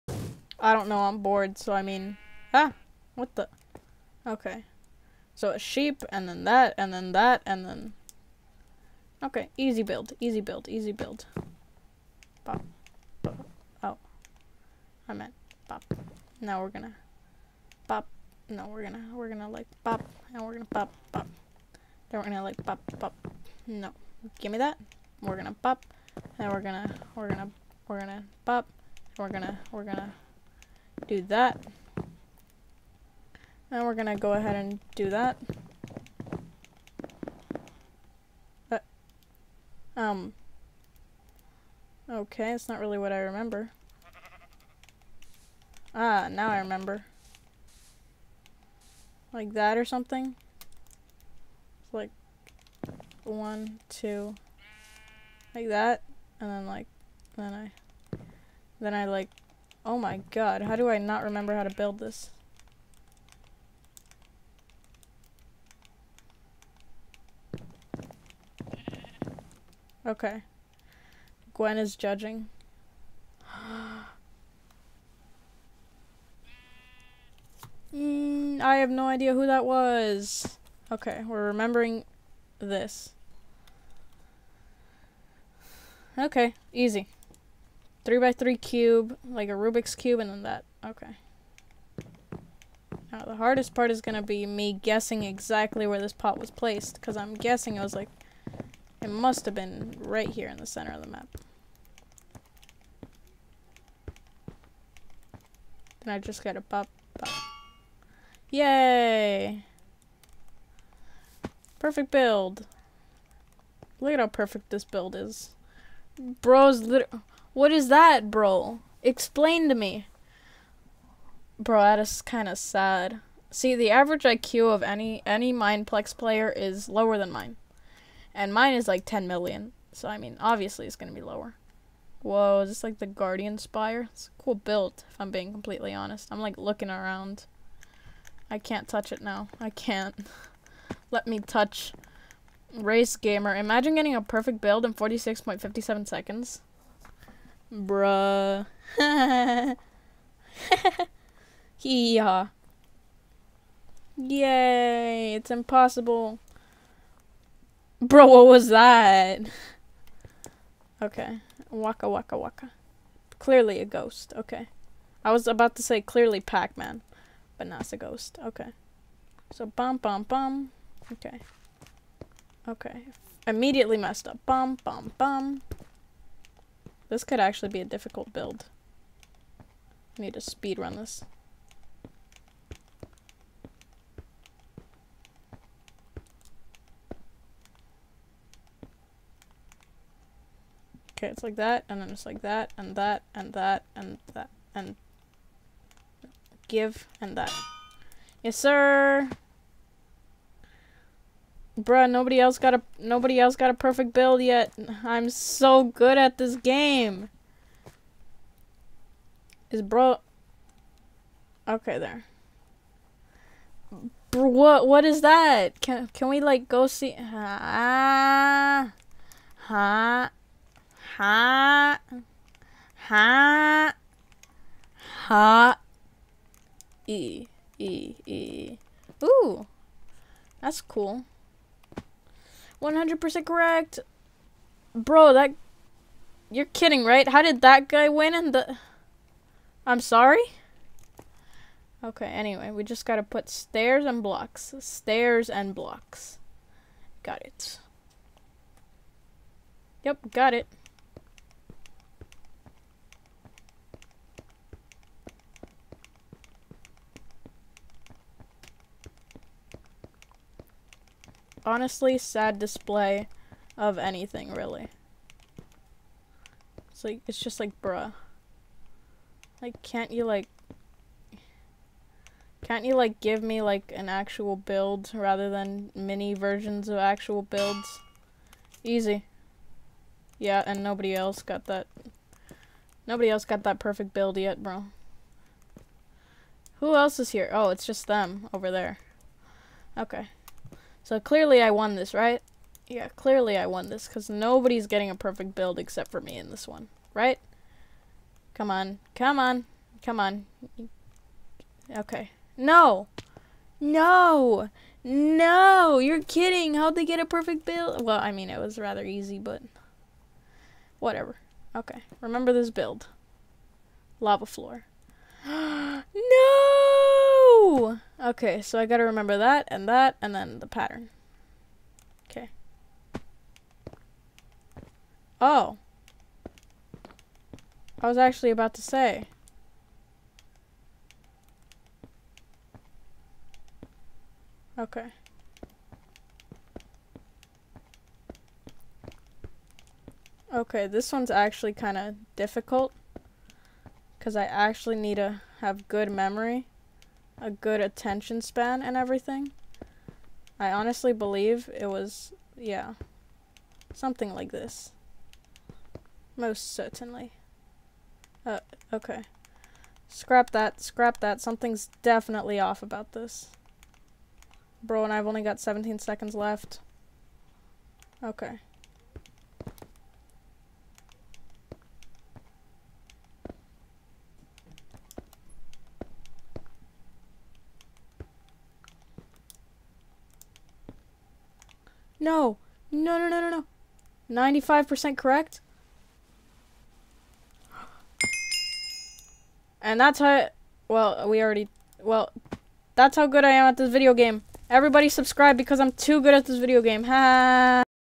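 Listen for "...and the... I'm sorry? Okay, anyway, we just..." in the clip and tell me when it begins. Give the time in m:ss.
3:58.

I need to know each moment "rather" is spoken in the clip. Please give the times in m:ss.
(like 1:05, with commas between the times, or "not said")
4:35, 5:08.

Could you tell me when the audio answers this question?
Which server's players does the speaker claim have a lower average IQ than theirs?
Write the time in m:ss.
2:05.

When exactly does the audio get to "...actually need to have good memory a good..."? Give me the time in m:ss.
5:44.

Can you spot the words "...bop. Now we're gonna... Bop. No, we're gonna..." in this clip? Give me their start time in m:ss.
0:15.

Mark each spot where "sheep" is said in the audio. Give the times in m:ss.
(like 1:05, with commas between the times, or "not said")
0:05.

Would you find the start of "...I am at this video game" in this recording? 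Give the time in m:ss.
6:33.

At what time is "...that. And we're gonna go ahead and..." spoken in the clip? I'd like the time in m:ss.
0:31.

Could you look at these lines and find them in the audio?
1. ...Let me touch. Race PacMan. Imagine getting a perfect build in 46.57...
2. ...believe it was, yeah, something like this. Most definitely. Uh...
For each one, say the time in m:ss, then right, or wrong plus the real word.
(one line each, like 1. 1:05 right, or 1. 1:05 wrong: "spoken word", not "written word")
1. 2:21 wrong: "Gamer", not "PacMan"
2. 5:51 wrong: "certainly", not "definitely".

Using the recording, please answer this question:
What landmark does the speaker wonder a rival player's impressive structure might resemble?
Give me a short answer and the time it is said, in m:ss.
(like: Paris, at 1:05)
Guardian Spire, at 2:13.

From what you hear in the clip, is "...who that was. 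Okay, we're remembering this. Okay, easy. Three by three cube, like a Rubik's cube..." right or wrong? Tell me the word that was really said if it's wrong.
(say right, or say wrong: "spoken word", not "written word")
right.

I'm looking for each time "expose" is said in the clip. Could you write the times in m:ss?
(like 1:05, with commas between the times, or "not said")
not said.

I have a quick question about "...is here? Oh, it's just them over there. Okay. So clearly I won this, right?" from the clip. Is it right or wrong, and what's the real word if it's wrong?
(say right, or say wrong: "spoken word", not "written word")
right.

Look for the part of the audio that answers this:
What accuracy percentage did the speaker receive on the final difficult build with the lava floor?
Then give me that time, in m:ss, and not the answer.
6:24.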